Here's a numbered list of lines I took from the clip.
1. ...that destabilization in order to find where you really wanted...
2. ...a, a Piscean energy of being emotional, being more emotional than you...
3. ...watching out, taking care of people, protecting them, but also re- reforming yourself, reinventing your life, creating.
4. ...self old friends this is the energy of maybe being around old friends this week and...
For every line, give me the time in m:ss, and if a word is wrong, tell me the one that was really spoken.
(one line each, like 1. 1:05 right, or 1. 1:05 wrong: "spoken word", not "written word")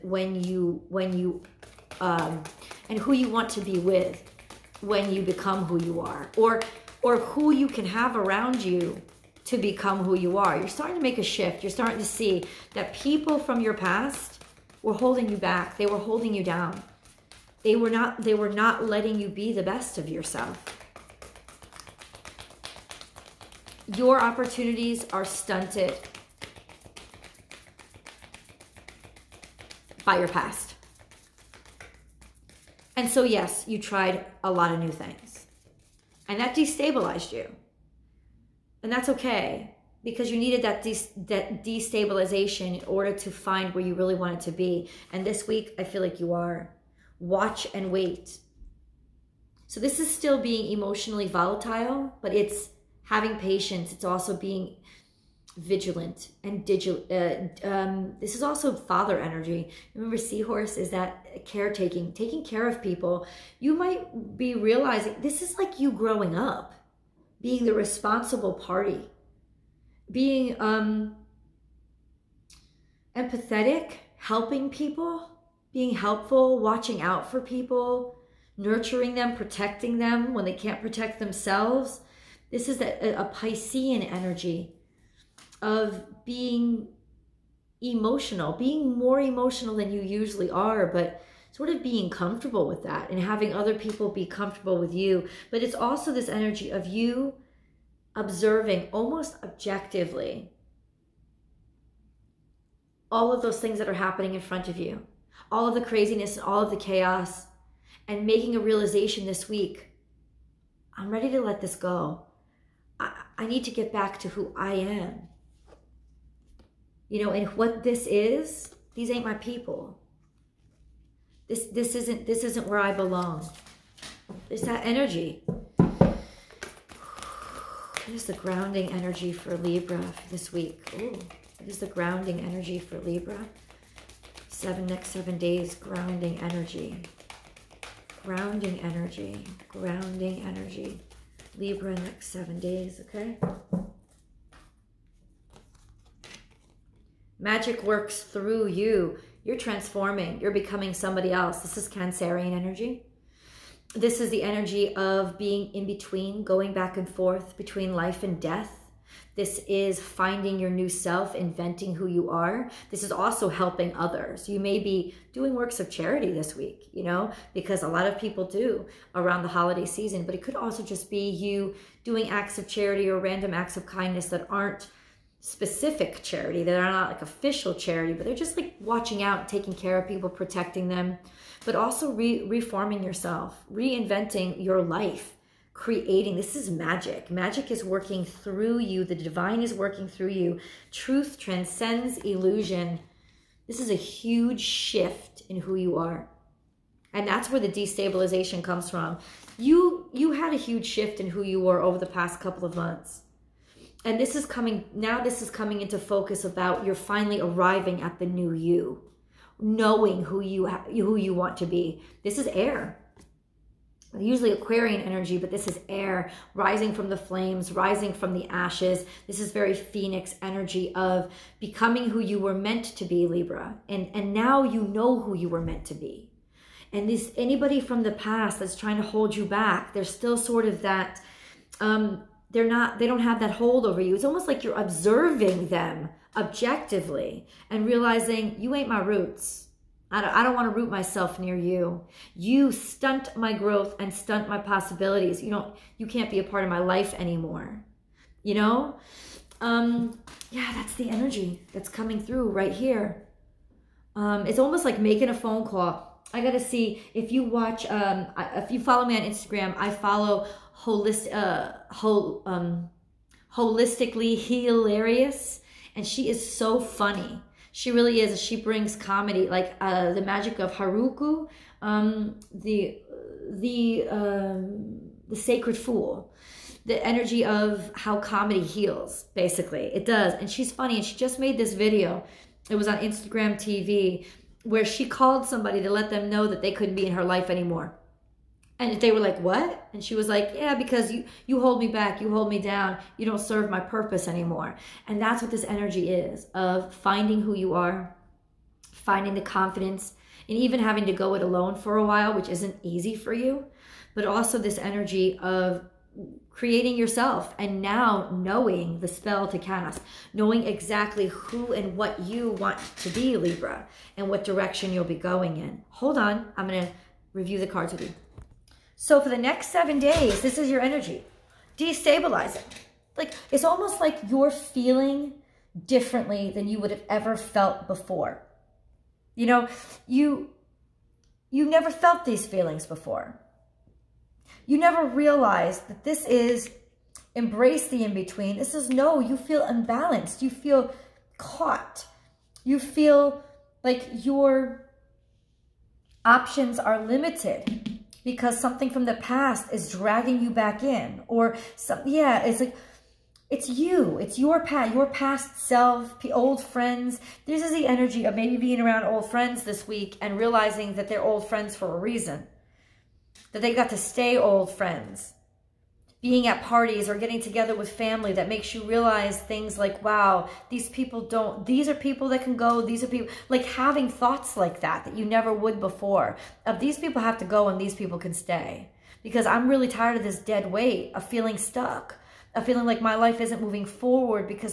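1. 0:41 right
2. 1:22 right
3. 2:58 right
4. 5:55 right.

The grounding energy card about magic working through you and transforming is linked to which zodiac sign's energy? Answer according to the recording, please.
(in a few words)
Cancerian.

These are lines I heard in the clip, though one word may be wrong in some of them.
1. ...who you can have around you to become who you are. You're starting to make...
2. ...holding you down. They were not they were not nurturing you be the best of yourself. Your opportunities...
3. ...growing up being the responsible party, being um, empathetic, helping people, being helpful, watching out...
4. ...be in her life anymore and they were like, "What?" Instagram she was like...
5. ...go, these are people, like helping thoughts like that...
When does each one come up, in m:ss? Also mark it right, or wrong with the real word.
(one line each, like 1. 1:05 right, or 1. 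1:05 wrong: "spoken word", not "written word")
1. 0:07 right
2. 0:15 wrong: "letting", not "nurturing"
3. 1:05 right
4. 4:46 wrong: "And", not "Instagram"
5. 6:12 wrong: "having", not "helping".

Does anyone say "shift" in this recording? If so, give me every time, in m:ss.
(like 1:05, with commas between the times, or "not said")
0:11, 3:14, 3:20.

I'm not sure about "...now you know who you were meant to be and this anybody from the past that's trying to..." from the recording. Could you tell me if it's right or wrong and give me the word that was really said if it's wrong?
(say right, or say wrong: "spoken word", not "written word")
right.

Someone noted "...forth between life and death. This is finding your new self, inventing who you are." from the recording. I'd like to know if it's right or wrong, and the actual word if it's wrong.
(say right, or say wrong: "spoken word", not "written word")
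right.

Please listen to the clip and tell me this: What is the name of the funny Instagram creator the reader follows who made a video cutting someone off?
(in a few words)
Holistically Hilarious.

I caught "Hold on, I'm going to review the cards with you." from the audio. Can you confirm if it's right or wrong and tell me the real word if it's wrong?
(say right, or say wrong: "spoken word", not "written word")
right.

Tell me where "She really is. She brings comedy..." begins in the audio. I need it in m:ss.
4:27.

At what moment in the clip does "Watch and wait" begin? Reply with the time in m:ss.
0:47.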